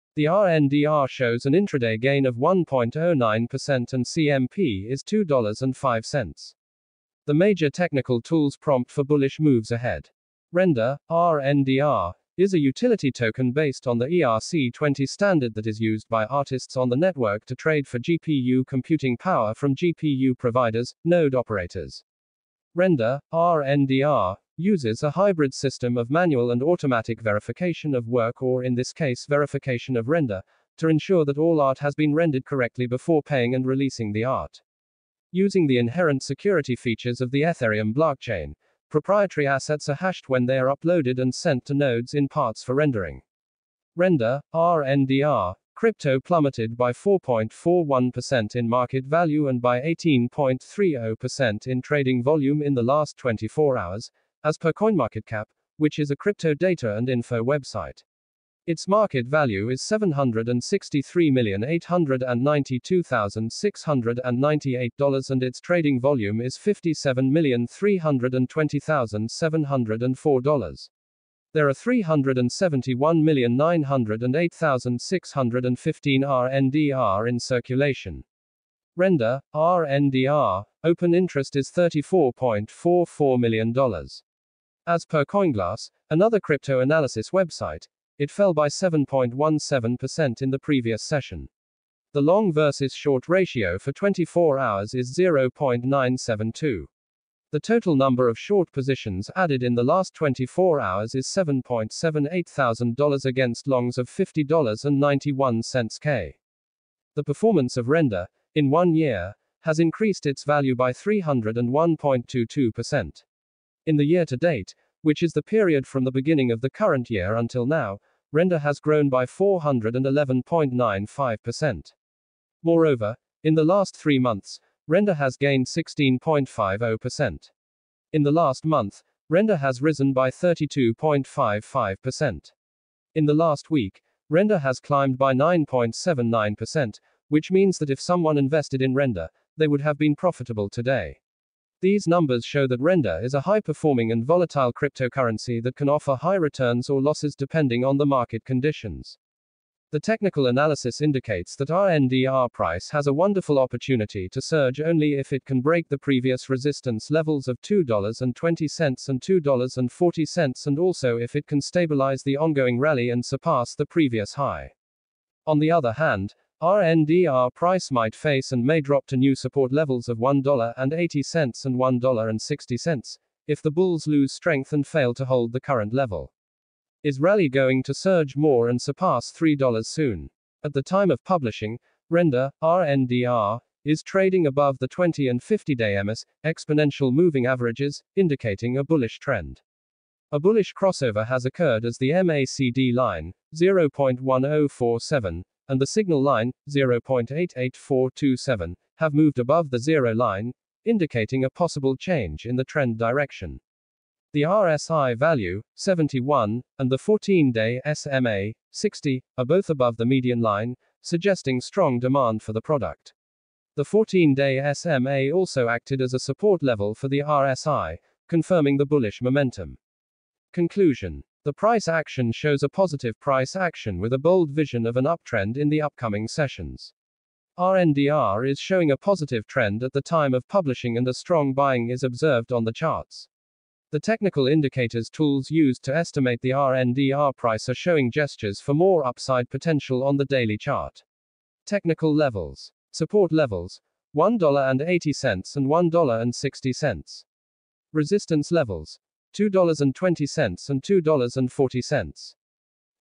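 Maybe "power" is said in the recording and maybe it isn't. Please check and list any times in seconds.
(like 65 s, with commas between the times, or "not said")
19 s.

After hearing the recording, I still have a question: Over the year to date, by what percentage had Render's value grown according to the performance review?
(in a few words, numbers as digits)
411.95%.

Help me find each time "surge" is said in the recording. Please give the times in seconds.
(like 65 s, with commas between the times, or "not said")
154 s, 177 s.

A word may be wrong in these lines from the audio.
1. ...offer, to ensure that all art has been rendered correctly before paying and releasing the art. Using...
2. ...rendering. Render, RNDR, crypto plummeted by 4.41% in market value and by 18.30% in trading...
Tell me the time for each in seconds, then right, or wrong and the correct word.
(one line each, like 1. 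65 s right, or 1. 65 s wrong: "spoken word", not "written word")
1. 30 s wrong: "render", not "offer"
2. 42 s right.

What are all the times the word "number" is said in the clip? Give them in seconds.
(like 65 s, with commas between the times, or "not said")
97 s, 142 s.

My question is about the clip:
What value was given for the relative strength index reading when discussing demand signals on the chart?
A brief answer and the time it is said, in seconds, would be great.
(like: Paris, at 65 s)
71, at 205 s.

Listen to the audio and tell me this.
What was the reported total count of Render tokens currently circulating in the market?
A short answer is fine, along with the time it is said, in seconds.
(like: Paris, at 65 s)
371,908,615, at 71 s.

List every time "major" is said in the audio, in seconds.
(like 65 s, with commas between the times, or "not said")
7 s.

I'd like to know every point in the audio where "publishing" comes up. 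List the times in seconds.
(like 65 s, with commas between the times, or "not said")
181 s, 230 s.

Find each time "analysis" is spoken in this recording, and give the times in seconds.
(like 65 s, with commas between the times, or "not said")
86 s, 150 s.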